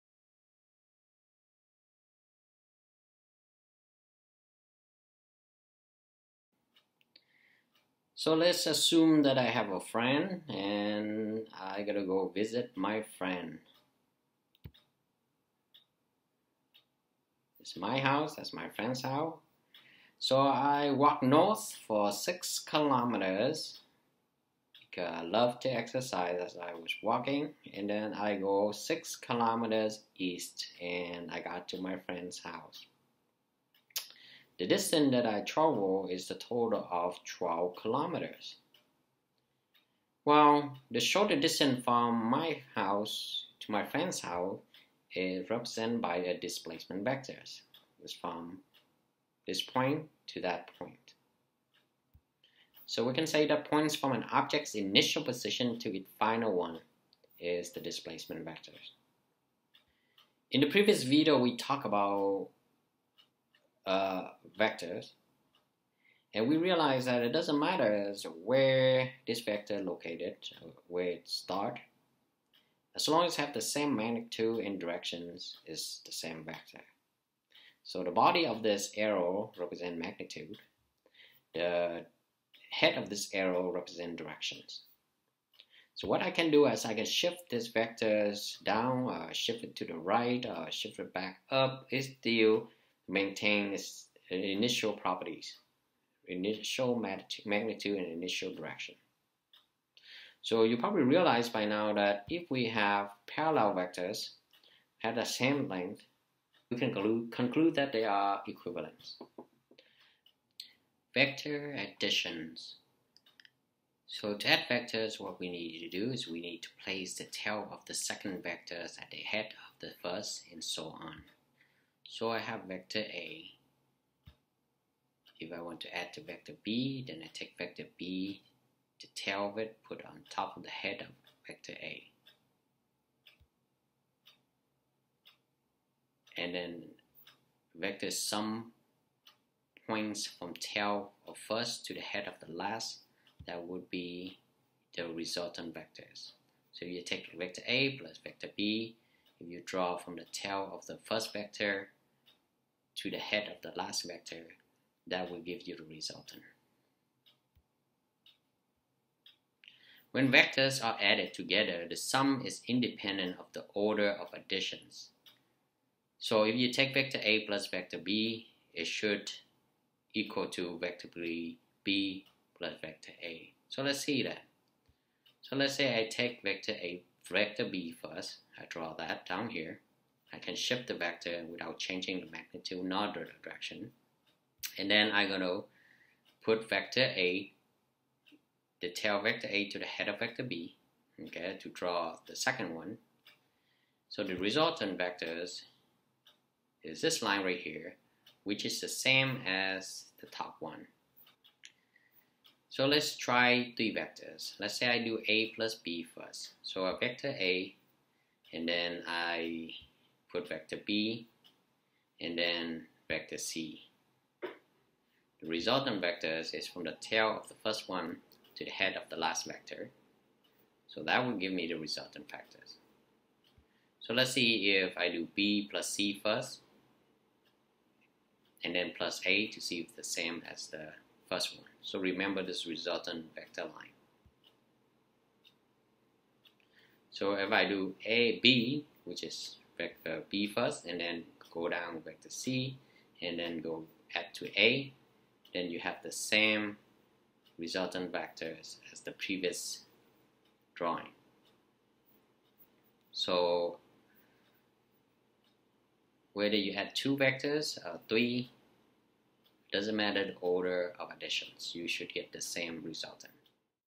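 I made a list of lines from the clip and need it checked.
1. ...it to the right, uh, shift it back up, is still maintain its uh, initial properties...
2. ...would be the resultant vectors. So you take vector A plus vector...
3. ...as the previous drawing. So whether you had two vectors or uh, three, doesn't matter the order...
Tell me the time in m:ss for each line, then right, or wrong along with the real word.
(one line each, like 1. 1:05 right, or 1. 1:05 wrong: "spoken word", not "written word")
1. 1:29 right
2. 2:23 right
3. 4:08 right.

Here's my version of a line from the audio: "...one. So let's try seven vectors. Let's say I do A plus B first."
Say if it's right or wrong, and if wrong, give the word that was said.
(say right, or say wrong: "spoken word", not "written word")
wrong: "three", not "seven".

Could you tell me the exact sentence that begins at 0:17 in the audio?
It's my house, that's my friend's house.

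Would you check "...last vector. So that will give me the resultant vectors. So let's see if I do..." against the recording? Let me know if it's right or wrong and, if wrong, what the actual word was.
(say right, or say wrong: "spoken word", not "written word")
right.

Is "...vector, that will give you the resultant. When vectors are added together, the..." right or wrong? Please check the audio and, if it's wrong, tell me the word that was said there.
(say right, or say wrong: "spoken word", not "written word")
right.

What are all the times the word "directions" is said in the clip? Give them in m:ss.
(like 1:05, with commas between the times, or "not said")
1:14, 1:24, 1:38, 3:03.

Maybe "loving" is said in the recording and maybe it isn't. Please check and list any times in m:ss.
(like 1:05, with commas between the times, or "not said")
not said.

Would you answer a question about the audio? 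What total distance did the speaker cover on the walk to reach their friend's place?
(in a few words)
12 kilometers.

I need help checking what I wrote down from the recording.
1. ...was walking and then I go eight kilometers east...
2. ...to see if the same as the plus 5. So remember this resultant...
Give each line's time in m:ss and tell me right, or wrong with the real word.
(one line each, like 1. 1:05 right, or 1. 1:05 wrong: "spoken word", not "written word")
1. 0:26 wrong: "six", not "eight"
2. 3:49 wrong: "1", not "5".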